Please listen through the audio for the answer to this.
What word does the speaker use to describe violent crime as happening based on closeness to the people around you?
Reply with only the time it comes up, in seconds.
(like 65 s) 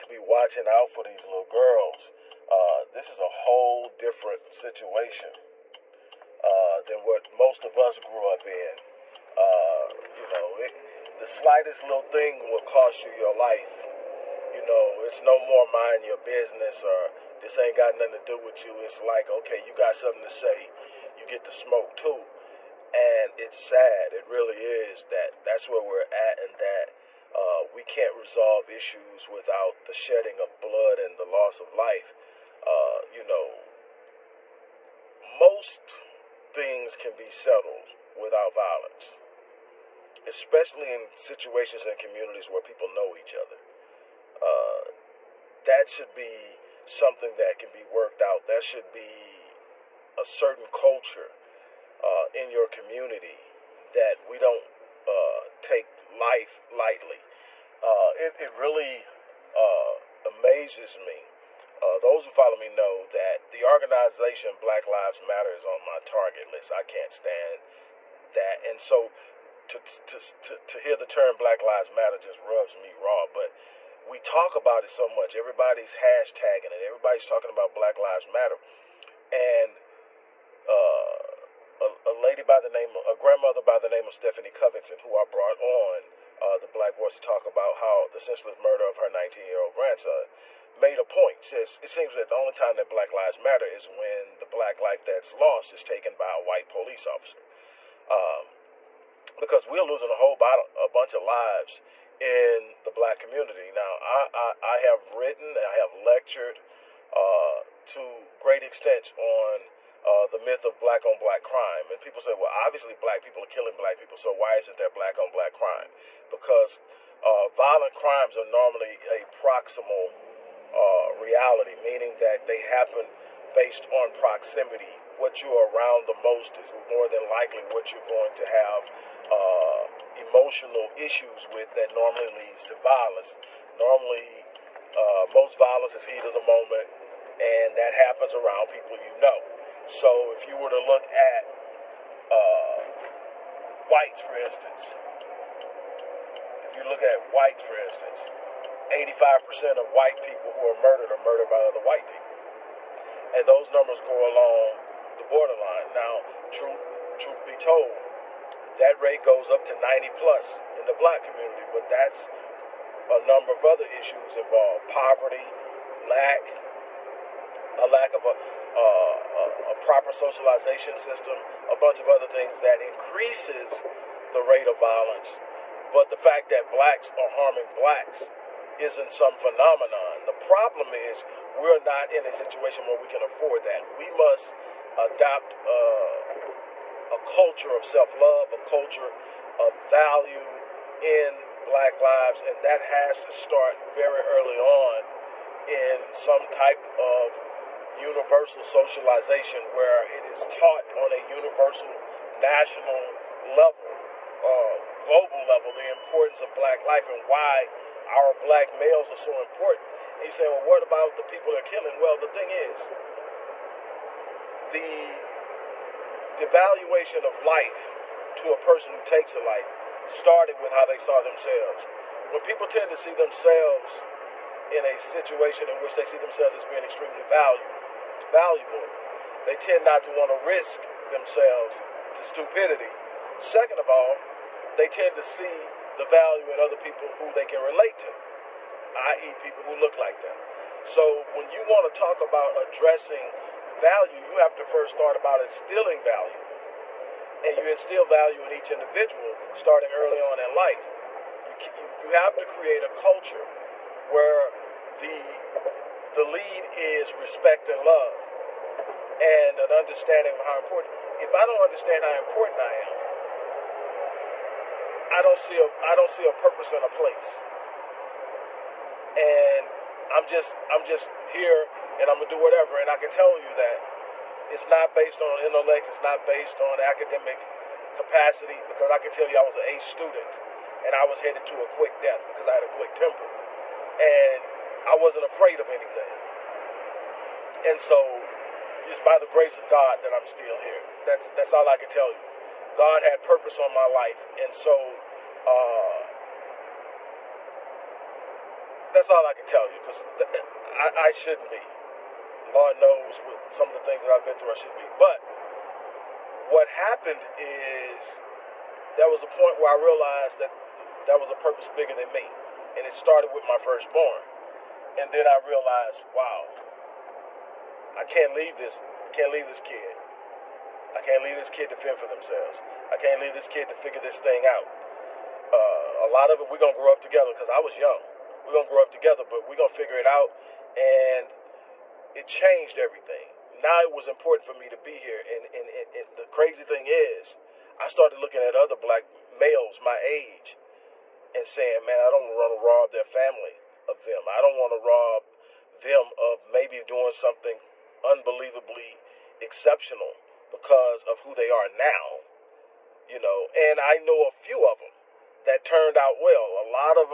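119 s.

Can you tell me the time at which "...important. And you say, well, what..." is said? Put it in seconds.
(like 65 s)
209 s.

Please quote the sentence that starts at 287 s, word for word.
And so it's by the grace of God that I'm still here.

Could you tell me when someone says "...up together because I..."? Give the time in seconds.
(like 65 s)
326 s.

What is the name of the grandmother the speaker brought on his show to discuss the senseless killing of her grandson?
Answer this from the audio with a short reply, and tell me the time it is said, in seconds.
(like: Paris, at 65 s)
Stephanie Covington, at 84 s.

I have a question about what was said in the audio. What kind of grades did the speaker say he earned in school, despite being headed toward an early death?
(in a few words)
A student.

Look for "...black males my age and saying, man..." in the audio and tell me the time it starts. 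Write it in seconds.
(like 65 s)
338 s.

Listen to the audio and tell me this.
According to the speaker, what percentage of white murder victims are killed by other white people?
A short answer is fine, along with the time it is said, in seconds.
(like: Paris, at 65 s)
85%, at 148 s.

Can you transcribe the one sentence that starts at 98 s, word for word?
Um, because we're losing a whole bottle, a bunch of lives in the black community.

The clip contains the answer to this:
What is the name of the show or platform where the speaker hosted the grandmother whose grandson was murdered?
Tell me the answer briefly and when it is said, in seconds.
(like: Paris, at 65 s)
The Black Voice, at 86 s.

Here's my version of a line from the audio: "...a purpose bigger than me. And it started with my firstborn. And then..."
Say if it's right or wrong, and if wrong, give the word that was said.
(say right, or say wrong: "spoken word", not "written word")
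right.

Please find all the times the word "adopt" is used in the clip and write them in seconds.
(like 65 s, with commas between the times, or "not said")
184 s.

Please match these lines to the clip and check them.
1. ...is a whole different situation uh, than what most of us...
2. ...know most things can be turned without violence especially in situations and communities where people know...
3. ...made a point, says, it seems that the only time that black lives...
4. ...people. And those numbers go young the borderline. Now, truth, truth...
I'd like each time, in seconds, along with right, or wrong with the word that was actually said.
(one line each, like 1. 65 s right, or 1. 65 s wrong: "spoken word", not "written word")
1. 3 s right
2. 33 s wrong: "settled", not "turned"
3. 90 s right
4. 152 s wrong: "along", not "young".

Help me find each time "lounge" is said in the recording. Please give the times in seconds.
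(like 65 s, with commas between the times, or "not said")
not said.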